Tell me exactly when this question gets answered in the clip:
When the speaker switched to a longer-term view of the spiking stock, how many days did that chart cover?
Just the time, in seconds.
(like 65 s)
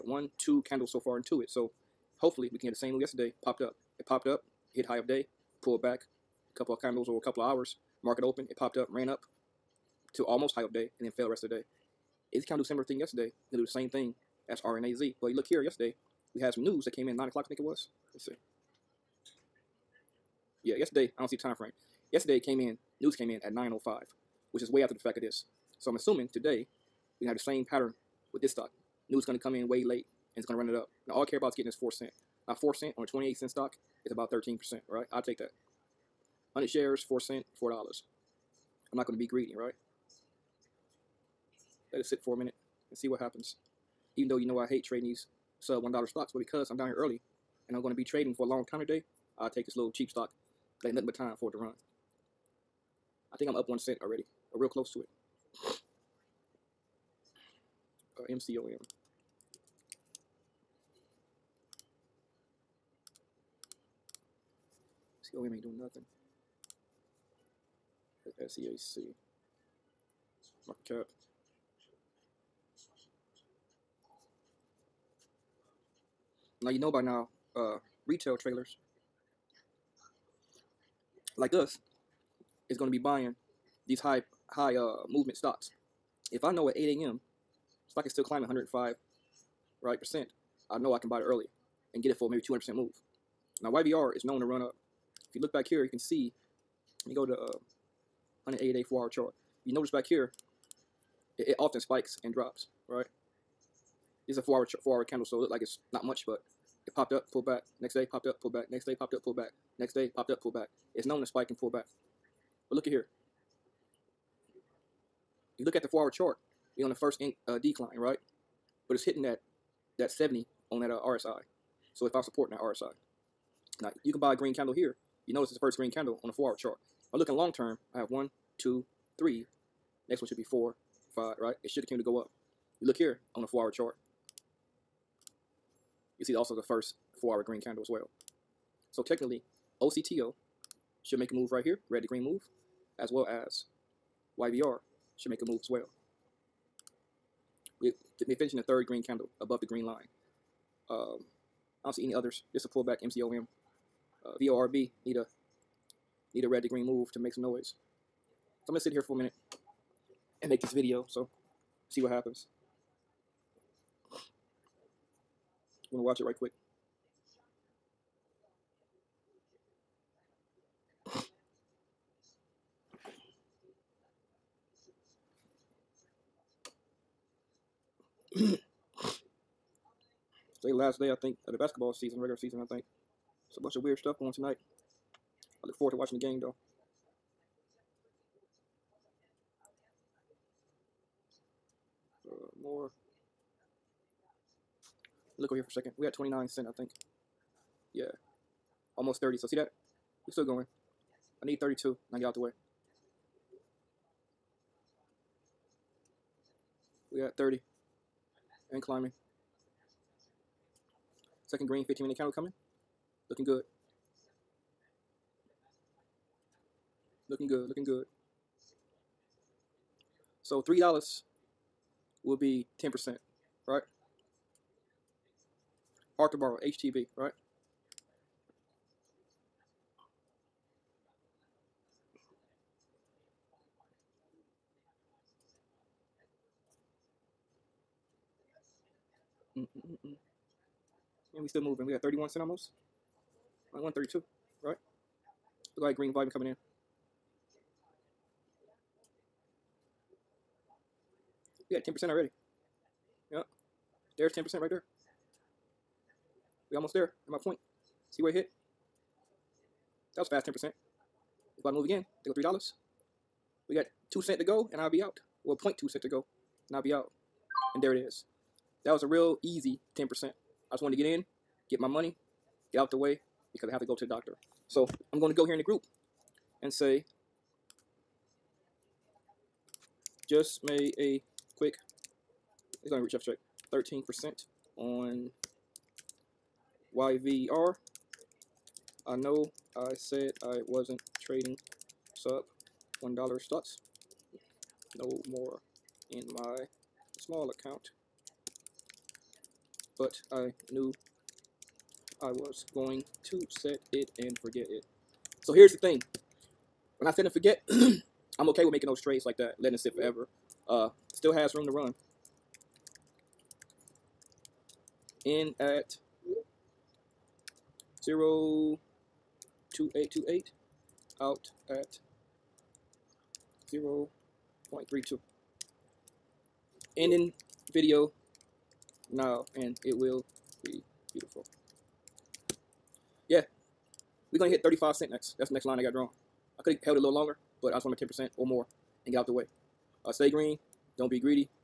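98 s.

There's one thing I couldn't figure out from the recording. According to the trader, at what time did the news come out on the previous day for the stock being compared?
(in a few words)
9:05.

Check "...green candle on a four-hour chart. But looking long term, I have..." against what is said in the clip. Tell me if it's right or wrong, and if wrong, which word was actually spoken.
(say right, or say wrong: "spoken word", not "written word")
right.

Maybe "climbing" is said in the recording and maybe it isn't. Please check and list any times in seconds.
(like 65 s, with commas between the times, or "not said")
88 s, 208 s.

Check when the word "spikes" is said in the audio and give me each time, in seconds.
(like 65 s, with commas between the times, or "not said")
101 s, 111 s.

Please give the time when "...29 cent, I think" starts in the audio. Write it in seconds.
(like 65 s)
196 s.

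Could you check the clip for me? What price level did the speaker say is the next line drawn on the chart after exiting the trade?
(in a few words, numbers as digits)
35 cents.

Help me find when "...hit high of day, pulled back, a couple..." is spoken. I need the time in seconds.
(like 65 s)
4 s.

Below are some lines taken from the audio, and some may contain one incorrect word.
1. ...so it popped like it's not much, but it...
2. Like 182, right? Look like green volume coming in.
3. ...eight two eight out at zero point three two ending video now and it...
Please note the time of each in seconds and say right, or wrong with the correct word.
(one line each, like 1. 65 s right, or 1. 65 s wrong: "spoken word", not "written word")
1. 105 s wrong: "looked", not "popped"
2. 243 s wrong: "132", not "182"
3. 319 s right.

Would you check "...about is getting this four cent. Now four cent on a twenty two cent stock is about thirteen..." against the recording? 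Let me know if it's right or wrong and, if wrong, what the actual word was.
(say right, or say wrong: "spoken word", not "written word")
wrong: "eight", not "two".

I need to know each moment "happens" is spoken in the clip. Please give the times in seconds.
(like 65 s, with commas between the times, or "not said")
43 s, 162 s.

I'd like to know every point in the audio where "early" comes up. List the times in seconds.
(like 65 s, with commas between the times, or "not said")
46 s, 91 s.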